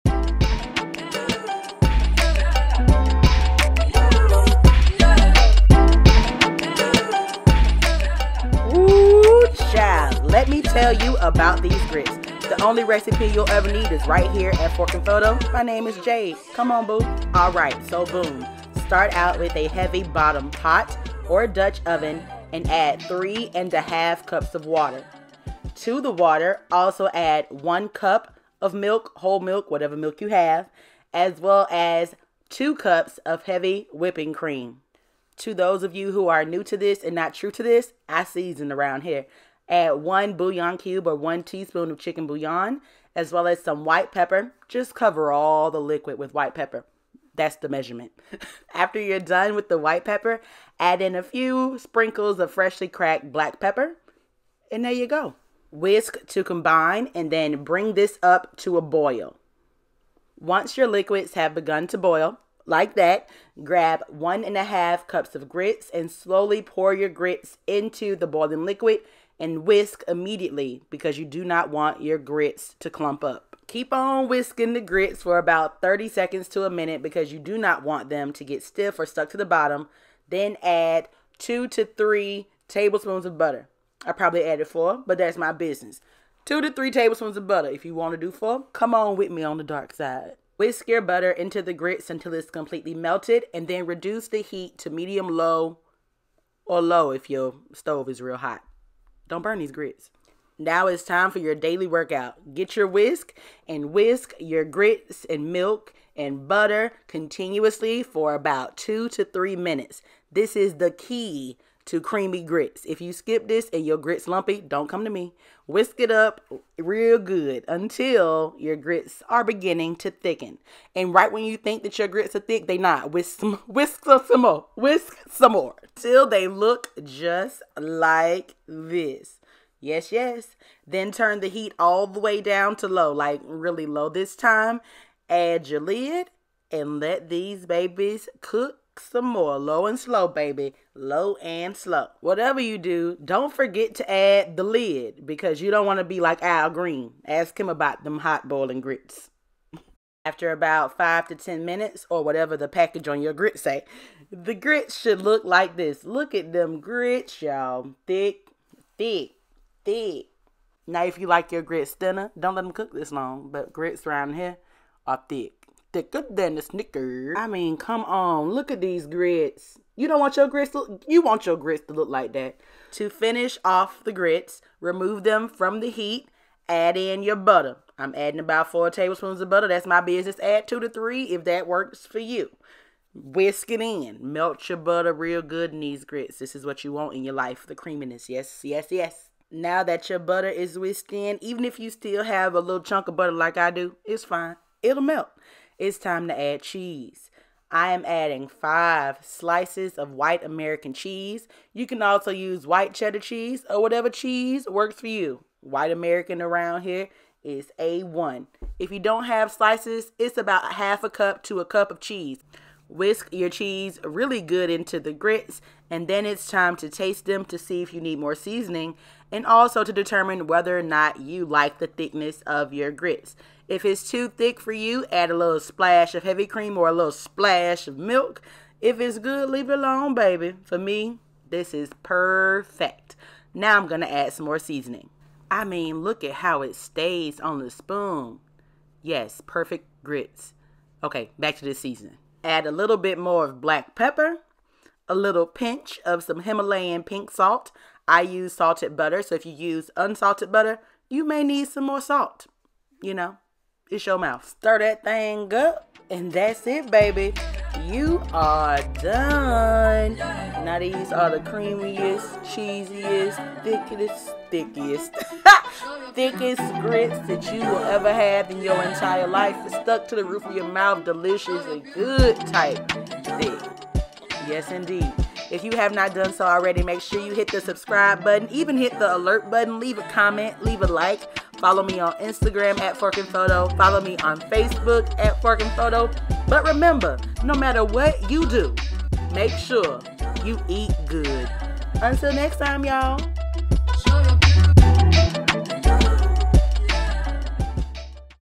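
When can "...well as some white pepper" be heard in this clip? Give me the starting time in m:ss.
0:43.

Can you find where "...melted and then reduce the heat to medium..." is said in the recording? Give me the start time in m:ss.
1:32.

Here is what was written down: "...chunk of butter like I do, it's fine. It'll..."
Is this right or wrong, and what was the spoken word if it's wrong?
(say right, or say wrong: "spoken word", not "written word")
right.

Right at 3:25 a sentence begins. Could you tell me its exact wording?
White American around here is A1.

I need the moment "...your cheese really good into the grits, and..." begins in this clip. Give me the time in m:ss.
3:33.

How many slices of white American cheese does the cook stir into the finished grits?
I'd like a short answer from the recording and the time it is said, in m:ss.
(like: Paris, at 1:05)
5, at 3:18.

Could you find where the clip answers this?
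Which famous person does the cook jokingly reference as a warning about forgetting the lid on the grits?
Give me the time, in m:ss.
2:26.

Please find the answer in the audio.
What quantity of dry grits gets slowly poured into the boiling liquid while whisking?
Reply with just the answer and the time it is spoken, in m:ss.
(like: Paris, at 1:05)
1.5 cups, at 1:04.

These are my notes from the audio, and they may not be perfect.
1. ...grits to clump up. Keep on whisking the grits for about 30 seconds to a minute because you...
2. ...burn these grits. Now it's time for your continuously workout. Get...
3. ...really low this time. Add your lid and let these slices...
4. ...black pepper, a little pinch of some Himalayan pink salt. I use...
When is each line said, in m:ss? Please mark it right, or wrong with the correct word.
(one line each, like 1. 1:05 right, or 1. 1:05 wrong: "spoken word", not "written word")
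1. 1:12 right
2. 1:39 wrong: "daily", not "continuously"
3. 2:13 wrong: "babies", not "slices"
4. 4:03 right.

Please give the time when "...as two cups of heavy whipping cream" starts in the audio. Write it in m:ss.
0:31.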